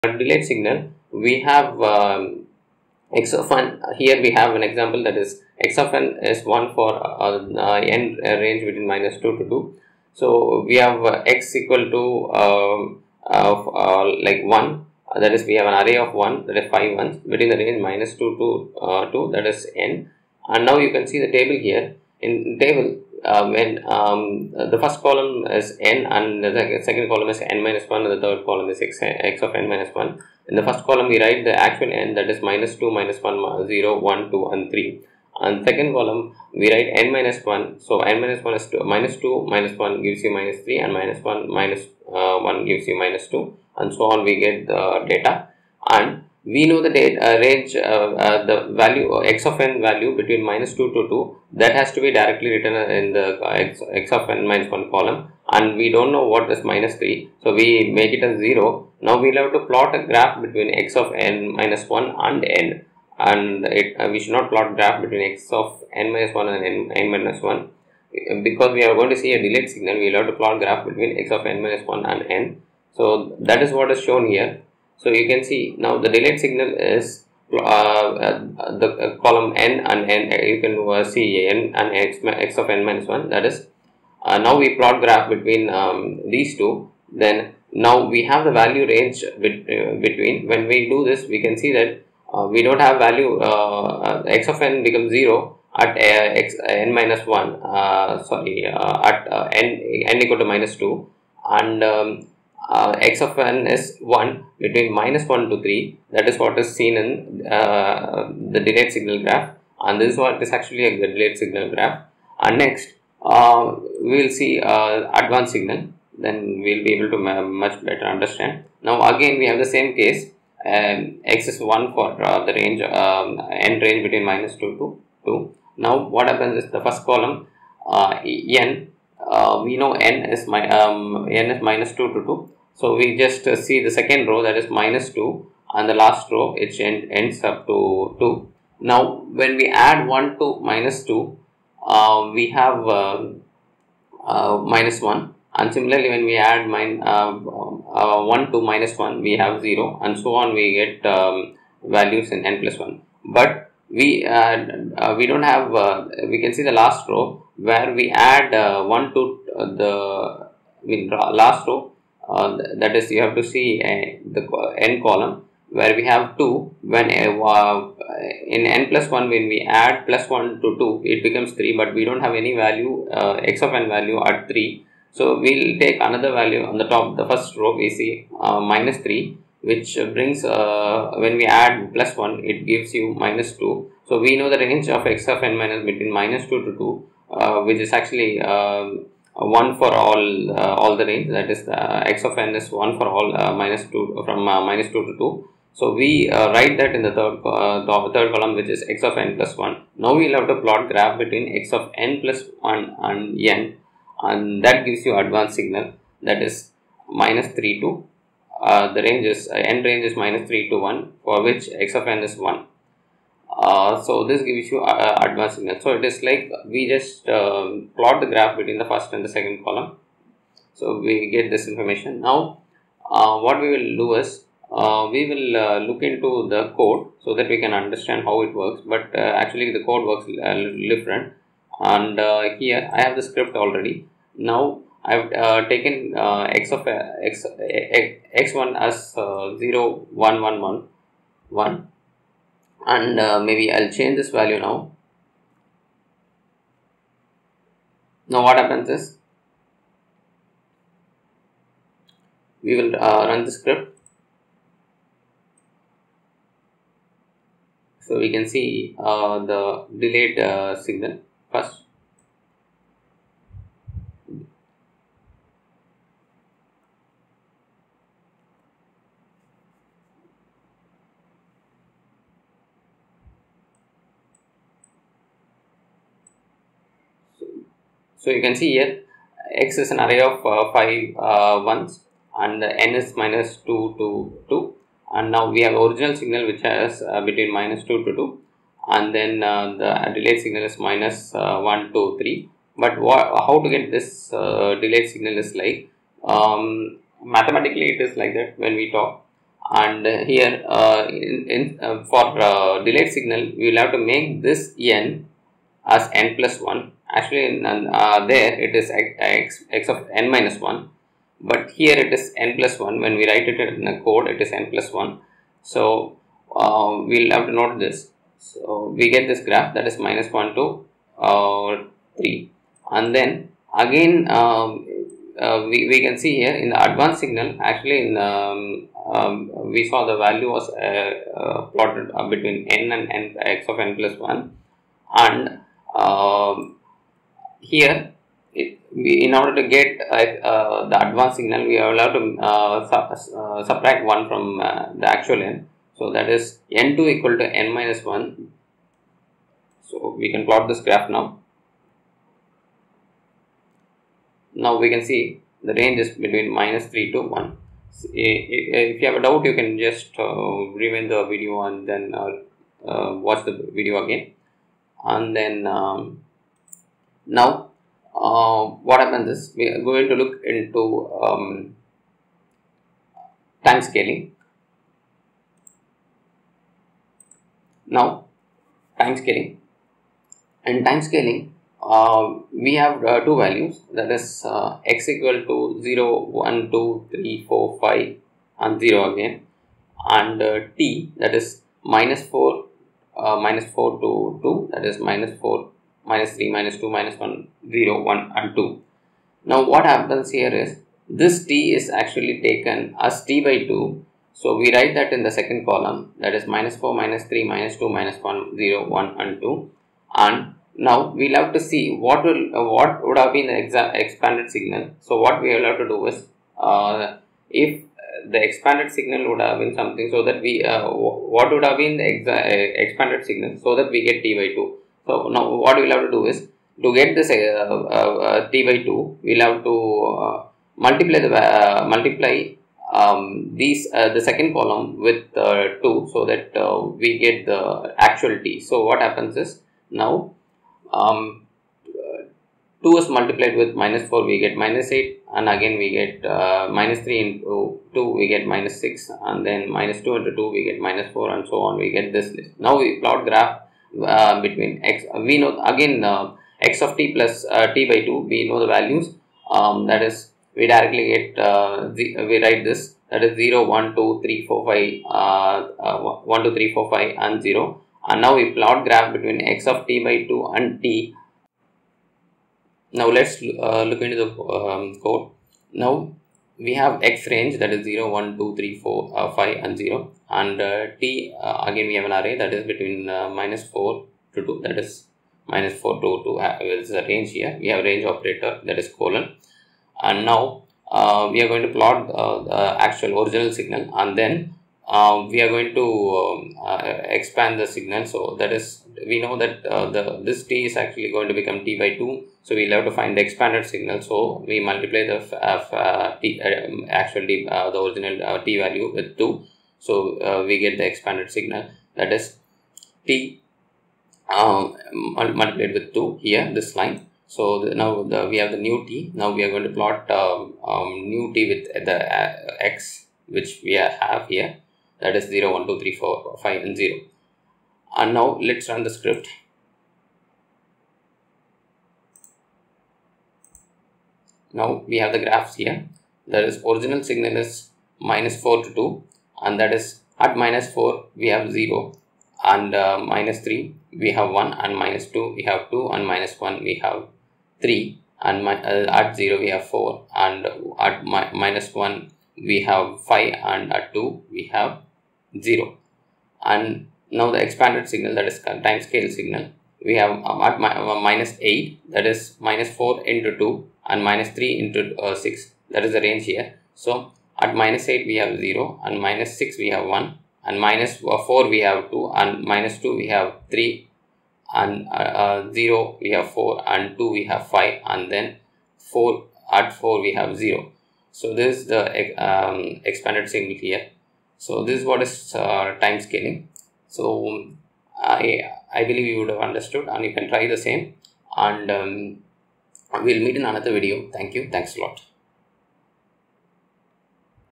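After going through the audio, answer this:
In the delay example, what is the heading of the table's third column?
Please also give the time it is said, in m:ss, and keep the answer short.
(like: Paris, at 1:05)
x of n minus 1, at 0:28.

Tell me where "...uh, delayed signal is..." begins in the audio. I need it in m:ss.
4:54.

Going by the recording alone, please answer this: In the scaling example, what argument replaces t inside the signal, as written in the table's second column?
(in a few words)
t by 2.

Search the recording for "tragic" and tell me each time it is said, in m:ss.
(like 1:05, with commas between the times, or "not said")
not said.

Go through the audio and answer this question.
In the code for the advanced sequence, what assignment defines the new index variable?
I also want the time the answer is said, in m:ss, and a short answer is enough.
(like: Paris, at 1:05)
n2 = n - 1, at 5:46.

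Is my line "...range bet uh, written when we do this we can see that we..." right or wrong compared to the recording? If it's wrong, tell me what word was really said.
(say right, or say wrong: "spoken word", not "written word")
wrong: "between", not "written".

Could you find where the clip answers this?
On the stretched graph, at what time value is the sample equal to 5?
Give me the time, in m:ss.
9:36.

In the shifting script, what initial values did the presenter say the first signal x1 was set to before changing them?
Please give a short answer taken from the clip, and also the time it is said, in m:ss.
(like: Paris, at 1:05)
0, 1, 1, 1, 1, at 3:59.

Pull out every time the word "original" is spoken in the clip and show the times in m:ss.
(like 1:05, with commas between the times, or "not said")
4:45, 8:13, 8:27, 8:56.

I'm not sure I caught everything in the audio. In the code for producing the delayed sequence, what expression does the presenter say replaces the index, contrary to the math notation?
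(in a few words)
n plus 1.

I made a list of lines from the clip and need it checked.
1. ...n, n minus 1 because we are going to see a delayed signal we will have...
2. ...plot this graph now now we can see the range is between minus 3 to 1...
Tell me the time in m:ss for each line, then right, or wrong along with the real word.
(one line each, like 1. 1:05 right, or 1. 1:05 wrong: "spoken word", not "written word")
1. 1:06 right
2. 5:50 right.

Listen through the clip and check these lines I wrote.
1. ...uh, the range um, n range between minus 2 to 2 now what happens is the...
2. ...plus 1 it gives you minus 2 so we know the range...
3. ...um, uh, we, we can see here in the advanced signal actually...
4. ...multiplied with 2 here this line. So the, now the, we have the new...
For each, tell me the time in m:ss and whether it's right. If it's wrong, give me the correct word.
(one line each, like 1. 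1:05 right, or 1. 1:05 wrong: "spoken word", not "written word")
1. 2:02 right
2. 3:01 right
3. 5:24 right
4. 8:34 right.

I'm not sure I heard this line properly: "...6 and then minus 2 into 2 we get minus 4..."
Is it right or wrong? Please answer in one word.
right.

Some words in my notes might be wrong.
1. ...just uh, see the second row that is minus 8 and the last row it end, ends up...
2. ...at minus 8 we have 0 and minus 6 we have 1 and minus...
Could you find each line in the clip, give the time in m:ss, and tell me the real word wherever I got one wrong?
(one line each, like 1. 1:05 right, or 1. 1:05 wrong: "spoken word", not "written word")
1. 2:13 wrong: "2", not "8"
2. 9:27 right.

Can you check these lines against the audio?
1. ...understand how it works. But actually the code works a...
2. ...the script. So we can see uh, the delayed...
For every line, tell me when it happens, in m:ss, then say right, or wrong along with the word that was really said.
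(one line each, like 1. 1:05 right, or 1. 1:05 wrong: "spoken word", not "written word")
1. 3:47 right
2. 4:13 right.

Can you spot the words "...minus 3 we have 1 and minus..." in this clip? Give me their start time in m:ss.
9:02.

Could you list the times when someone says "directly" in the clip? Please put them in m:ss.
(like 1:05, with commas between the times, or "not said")
0:52, 7:40.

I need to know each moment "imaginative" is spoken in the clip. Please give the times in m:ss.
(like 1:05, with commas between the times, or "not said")
not said.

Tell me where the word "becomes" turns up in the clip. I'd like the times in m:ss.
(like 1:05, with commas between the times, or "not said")
1:34, 2:51, 8:21.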